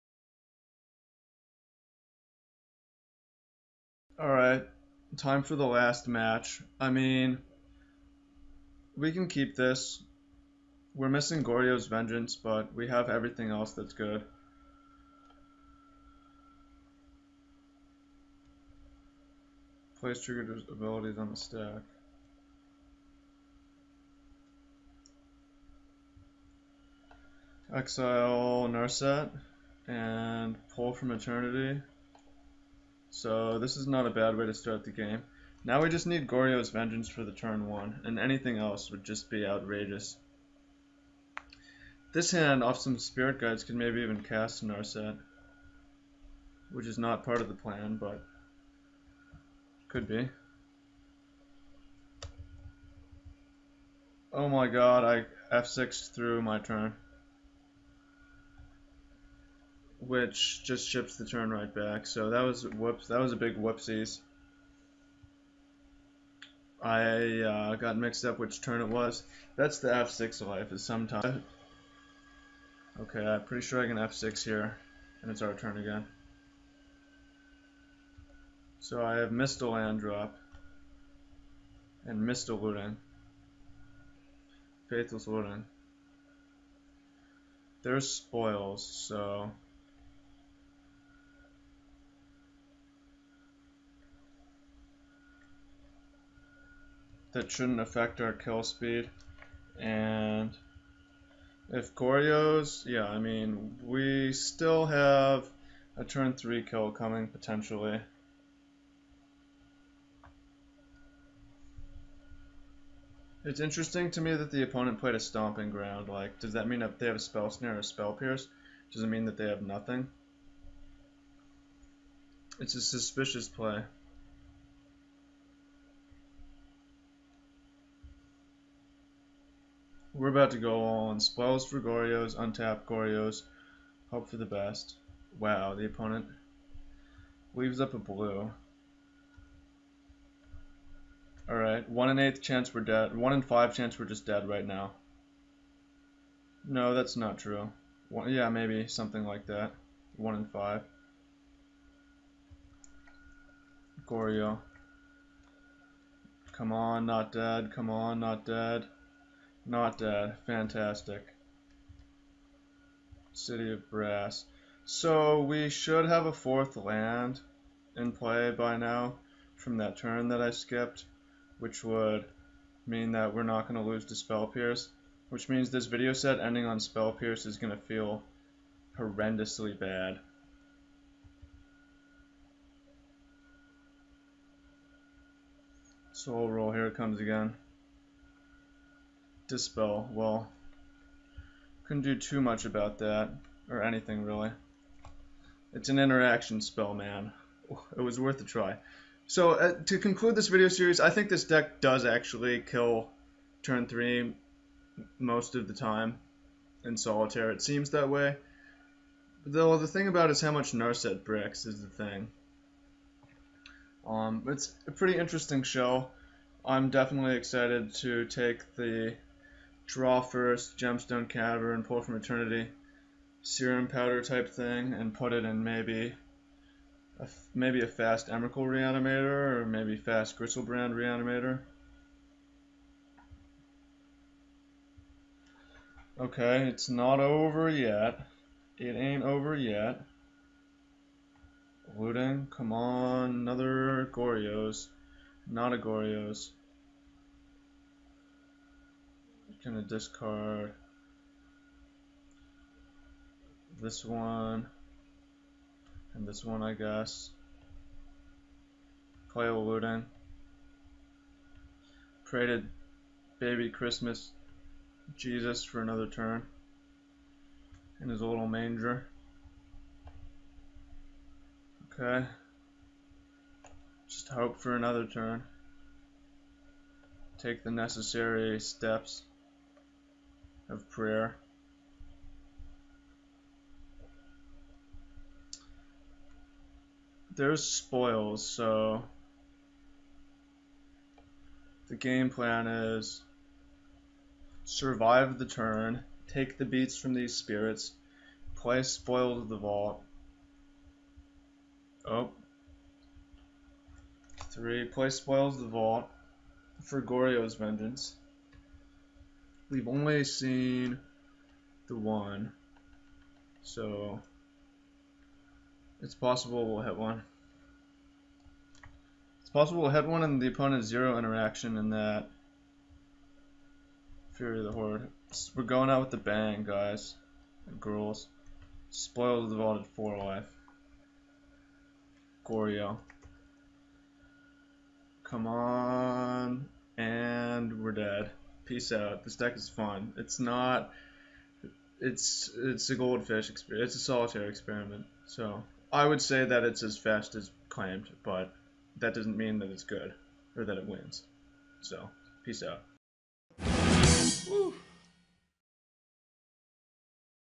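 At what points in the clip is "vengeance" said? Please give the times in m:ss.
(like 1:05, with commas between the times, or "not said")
0:11, 0:36, 5:07.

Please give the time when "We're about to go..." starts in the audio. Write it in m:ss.
2:10.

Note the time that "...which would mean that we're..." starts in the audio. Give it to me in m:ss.
2:51.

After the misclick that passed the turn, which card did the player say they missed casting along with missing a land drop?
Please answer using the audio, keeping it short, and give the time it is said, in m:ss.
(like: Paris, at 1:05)
Faithless Looting, at 1:24.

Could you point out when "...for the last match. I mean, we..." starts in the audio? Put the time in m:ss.
0:05.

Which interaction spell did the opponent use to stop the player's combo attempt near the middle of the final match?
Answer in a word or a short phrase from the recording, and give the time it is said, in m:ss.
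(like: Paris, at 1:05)
Dispel, at 3:09.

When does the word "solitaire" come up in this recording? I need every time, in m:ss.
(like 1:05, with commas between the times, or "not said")
3:26, 5:44.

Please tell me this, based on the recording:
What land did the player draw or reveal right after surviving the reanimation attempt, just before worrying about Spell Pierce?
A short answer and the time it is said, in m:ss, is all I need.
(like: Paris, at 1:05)
City of Brass, at 2:43.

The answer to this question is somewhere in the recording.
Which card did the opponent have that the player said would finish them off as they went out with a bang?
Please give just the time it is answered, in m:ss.
5:24.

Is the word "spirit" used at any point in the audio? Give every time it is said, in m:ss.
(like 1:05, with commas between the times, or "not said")
0:42, 4:57.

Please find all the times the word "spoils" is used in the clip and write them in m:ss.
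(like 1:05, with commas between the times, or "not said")
1:28, 2:11, 4:47, 4:58, 5:05, 5:28.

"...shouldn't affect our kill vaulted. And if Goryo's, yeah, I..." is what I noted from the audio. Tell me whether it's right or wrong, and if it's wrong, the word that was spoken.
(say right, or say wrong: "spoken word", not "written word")
wrong: "speed", not "vaulted".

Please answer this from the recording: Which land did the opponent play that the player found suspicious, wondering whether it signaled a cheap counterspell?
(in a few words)
Stomping Ground.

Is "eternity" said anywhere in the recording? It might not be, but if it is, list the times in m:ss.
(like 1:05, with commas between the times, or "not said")
0:31, 3:42.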